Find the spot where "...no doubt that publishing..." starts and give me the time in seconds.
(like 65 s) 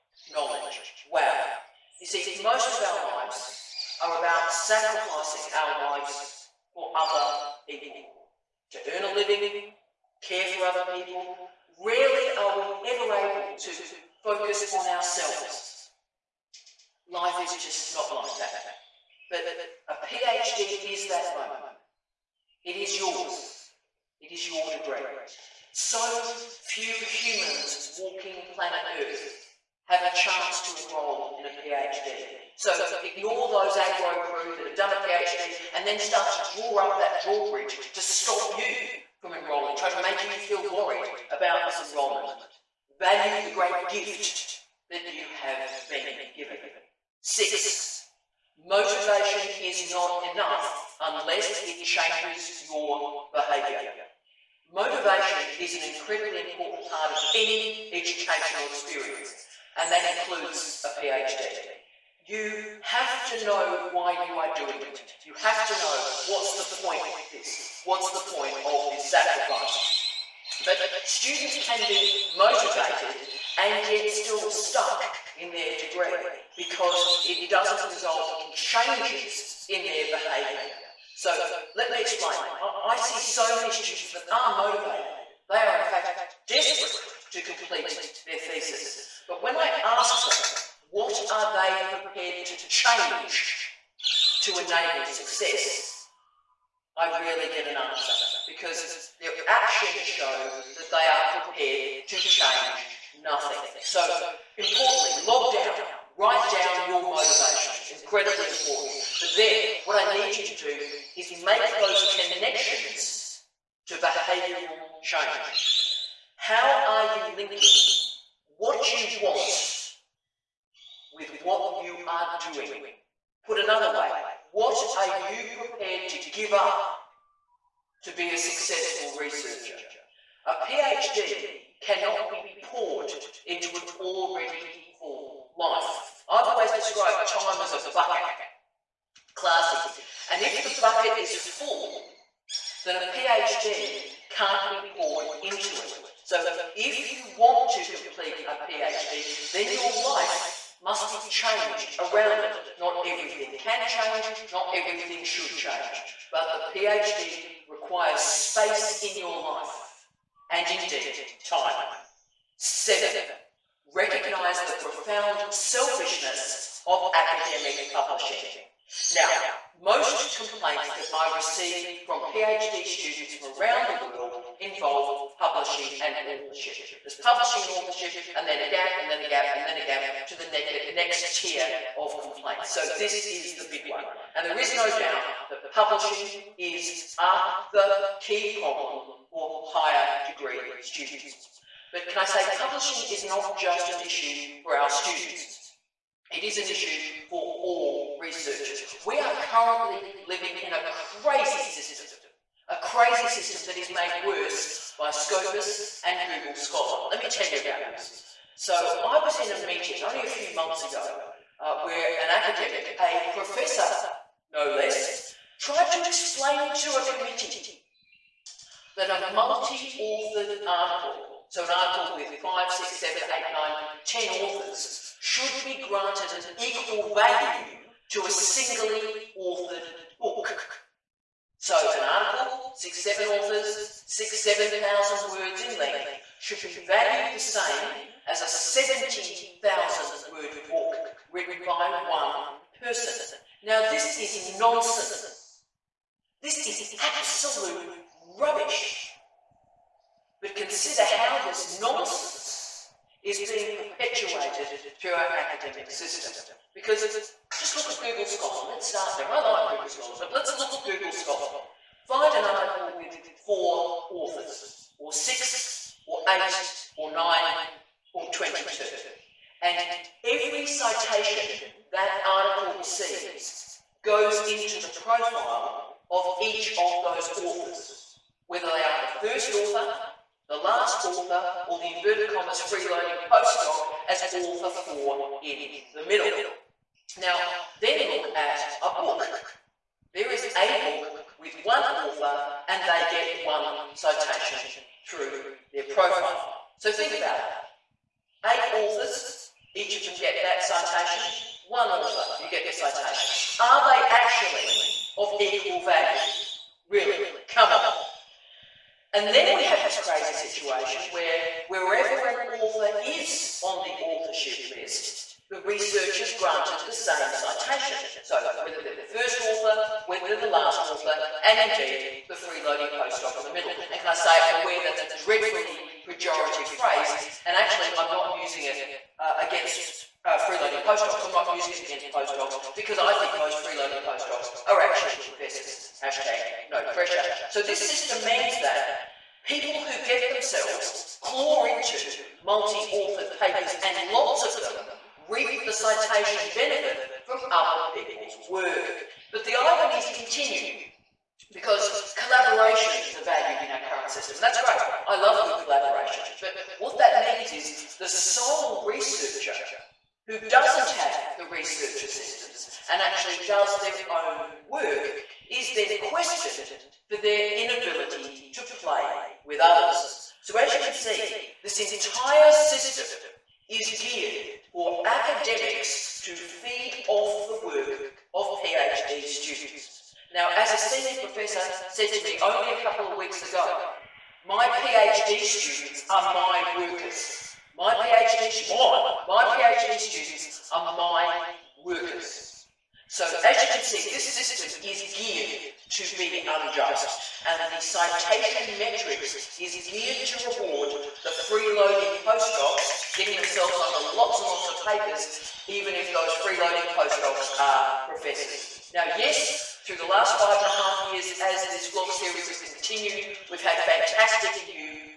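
184 s.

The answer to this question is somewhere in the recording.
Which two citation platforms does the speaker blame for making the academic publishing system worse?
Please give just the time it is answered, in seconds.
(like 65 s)
205 s.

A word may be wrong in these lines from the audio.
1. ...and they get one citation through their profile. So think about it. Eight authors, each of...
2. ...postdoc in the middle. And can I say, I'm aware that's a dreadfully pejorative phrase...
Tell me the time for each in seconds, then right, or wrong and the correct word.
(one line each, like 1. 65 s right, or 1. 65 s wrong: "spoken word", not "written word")
1. 292 s right
2. 322 s right.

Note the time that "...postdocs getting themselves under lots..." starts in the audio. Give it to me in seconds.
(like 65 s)
402 s.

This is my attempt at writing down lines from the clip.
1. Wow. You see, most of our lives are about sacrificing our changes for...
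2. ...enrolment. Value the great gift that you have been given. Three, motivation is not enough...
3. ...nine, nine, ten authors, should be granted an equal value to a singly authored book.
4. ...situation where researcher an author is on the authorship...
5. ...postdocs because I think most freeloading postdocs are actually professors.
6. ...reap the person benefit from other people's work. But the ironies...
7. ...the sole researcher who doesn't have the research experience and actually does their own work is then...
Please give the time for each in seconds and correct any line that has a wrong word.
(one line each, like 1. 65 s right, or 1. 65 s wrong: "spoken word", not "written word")
1. 1 s wrong: "lives", not "changes"
2. 41 s wrong: "Six", not "Three"
3. 223 s wrong: "eight", not "nine"
4. 310 s wrong: "wherever", not "researcher"
5. 332 s right
6. 345 s wrong: "citation", not "person"
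7. 357 s wrong: "assistance", not "experience".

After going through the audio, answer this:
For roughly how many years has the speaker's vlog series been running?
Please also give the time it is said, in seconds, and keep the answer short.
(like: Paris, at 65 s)
5.5 years, at 410 s.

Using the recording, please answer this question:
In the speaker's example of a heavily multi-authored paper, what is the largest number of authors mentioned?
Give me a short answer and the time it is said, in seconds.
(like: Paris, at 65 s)
22, at 268 s.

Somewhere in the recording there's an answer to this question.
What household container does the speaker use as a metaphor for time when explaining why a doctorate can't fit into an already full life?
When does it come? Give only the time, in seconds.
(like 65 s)
137 s.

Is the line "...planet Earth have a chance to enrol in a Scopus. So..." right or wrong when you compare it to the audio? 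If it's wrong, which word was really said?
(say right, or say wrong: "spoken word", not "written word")
wrong: "PhD", not "Scopus".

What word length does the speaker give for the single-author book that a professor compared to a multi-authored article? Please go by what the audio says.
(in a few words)
70,000 words.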